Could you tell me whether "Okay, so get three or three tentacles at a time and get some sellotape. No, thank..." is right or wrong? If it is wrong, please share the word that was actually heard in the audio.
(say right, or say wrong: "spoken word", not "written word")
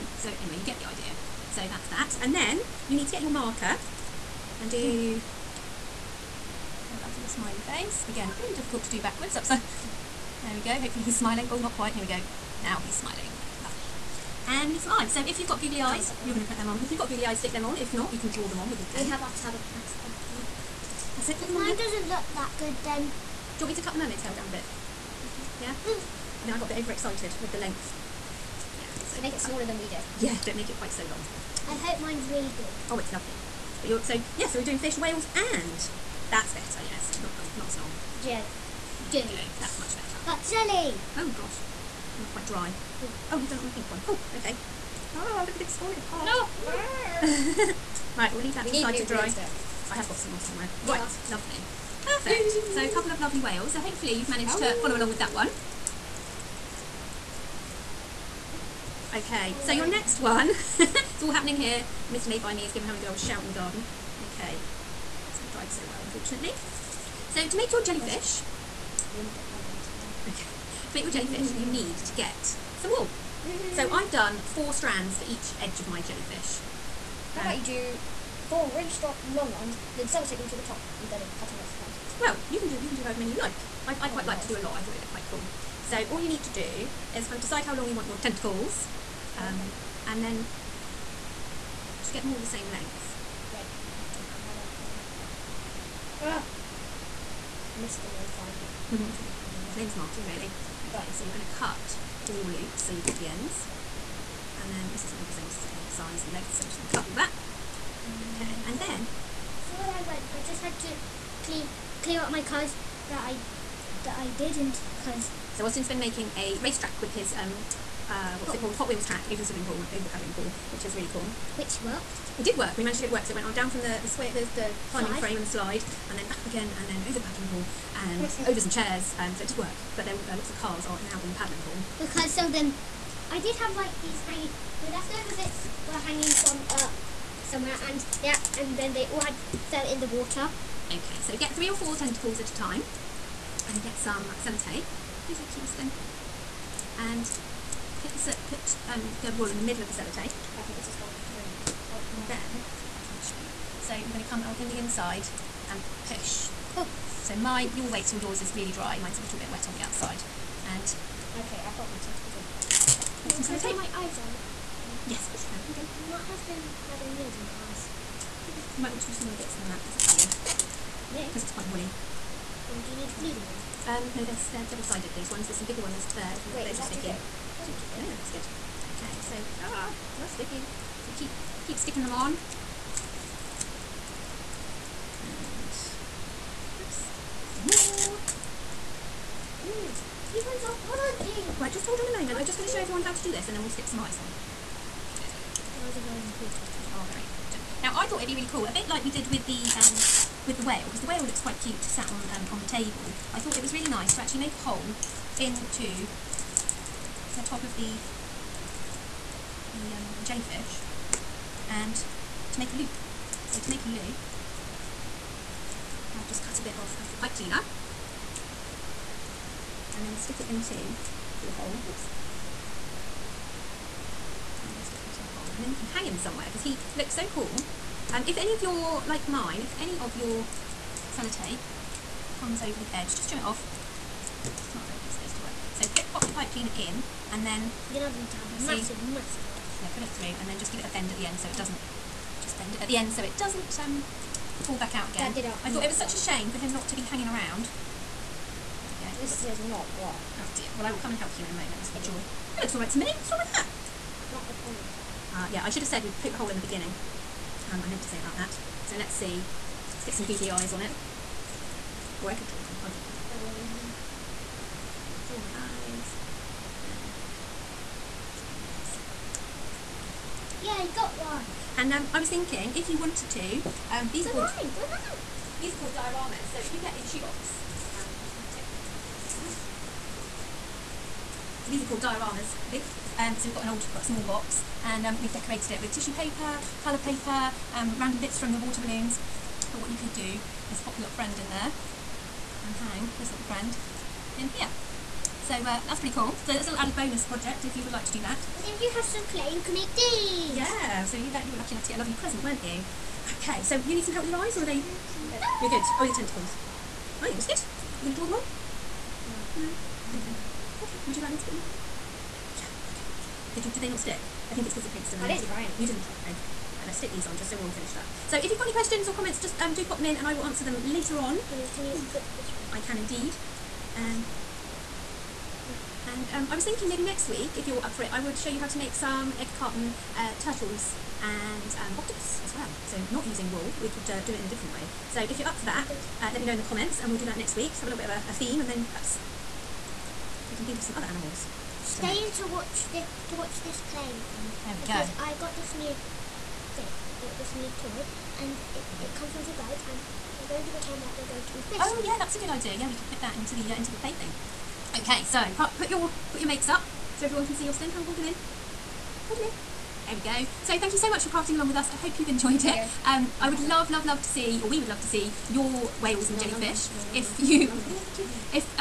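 wrong: "four", not "three".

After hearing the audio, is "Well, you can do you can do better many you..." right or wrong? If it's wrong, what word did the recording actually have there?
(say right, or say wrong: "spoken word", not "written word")
wrong: "however", not "better".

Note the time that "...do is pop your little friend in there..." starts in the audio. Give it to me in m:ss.
4:50.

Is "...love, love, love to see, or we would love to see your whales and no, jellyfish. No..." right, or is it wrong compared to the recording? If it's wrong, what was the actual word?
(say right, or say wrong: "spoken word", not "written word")
right.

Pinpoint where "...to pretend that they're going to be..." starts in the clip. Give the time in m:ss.
5:50.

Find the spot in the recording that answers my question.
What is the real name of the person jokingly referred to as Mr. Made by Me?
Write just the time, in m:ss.
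1:39.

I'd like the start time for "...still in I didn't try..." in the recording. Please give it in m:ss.
5:15.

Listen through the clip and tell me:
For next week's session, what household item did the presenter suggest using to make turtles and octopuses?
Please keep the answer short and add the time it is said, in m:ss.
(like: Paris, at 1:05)
Egg carton, at 5:29.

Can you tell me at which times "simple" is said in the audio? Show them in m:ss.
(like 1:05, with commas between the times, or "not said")
not said.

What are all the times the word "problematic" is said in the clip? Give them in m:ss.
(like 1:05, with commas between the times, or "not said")
not said.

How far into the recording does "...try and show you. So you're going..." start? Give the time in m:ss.
2:33.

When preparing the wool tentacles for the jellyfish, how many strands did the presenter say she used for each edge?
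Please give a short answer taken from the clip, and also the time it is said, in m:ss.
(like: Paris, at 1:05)
4, at 1:14.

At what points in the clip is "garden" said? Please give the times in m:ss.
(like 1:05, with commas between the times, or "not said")
1:03.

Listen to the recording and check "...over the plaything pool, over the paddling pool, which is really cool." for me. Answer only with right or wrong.
wrong.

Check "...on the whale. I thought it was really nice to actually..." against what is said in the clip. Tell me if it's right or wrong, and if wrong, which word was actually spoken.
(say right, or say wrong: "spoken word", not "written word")
wrong: "table", not "whale".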